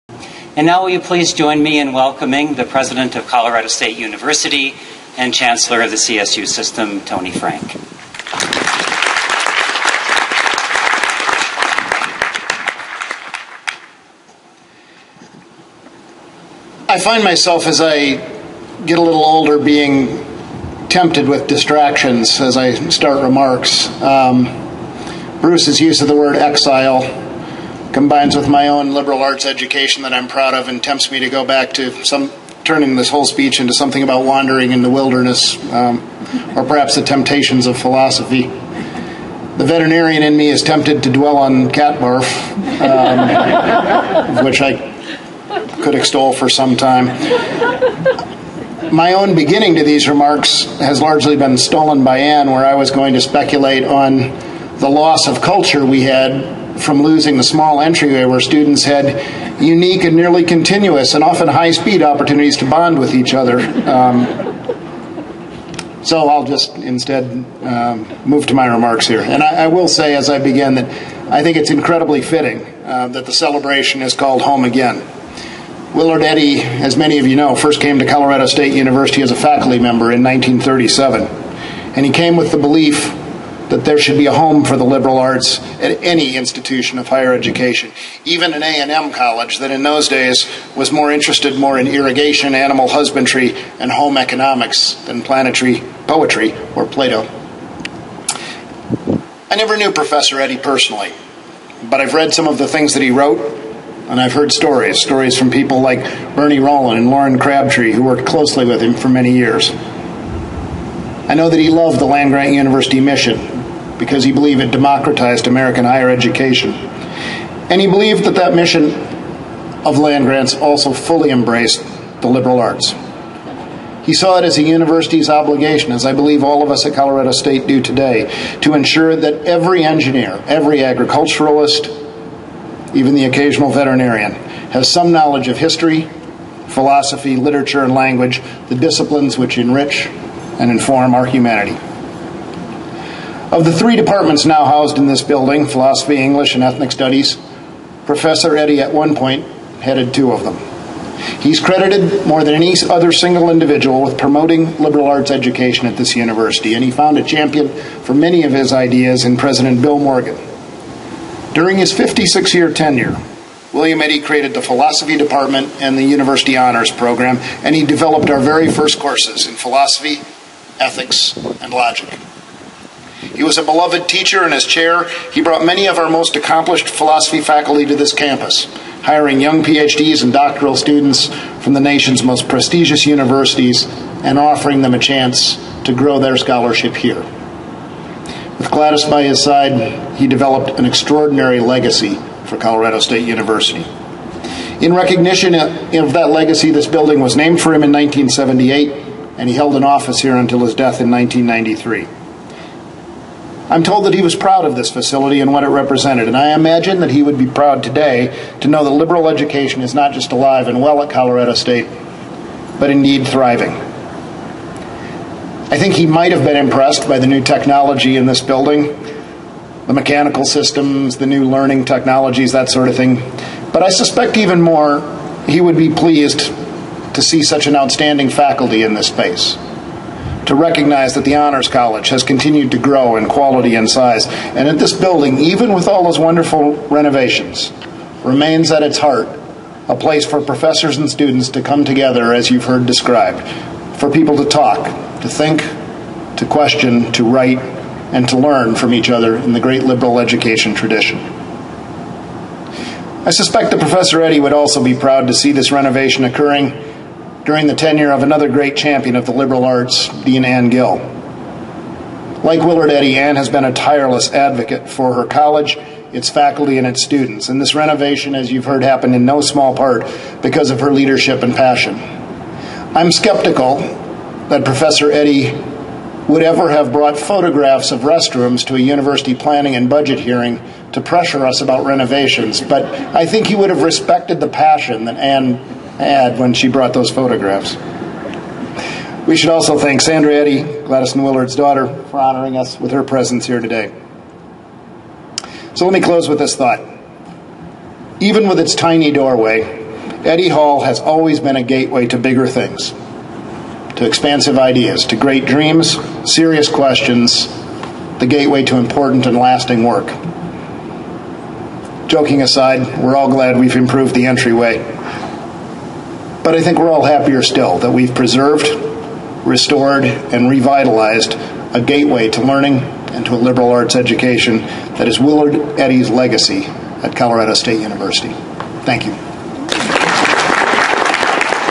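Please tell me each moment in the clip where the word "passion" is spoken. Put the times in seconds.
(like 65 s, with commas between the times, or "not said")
271 s, 284 s.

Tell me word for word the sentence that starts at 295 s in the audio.
So let me close with this thought.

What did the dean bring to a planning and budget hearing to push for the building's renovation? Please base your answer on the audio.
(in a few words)
Photographs of restrooms.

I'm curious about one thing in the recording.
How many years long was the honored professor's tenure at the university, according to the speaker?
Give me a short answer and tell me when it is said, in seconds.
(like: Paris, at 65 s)
56, at 161 s.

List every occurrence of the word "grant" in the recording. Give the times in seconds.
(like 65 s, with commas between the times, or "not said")
112 s, 120 s.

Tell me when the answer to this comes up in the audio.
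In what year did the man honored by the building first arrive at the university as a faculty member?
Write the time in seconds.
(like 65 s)
80 s.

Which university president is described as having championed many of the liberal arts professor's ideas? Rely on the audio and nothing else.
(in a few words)
Bill Morgan.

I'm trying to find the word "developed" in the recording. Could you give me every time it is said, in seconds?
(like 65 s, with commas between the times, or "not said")
167 s, 190 s.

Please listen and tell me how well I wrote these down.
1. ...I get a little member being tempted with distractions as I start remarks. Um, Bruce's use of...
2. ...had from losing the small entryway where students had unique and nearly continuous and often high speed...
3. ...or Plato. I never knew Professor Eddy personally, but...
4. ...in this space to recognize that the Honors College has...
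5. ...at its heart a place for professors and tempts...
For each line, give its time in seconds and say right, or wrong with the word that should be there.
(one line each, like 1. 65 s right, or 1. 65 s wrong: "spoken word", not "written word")
1. 17 s wrong: "older", not "member"
2. 56 s right
3. 96 s right
4. 228 s right
5. 238 s wrong: "students", not "tempts".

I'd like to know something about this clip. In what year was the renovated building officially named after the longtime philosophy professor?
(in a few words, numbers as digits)
1978.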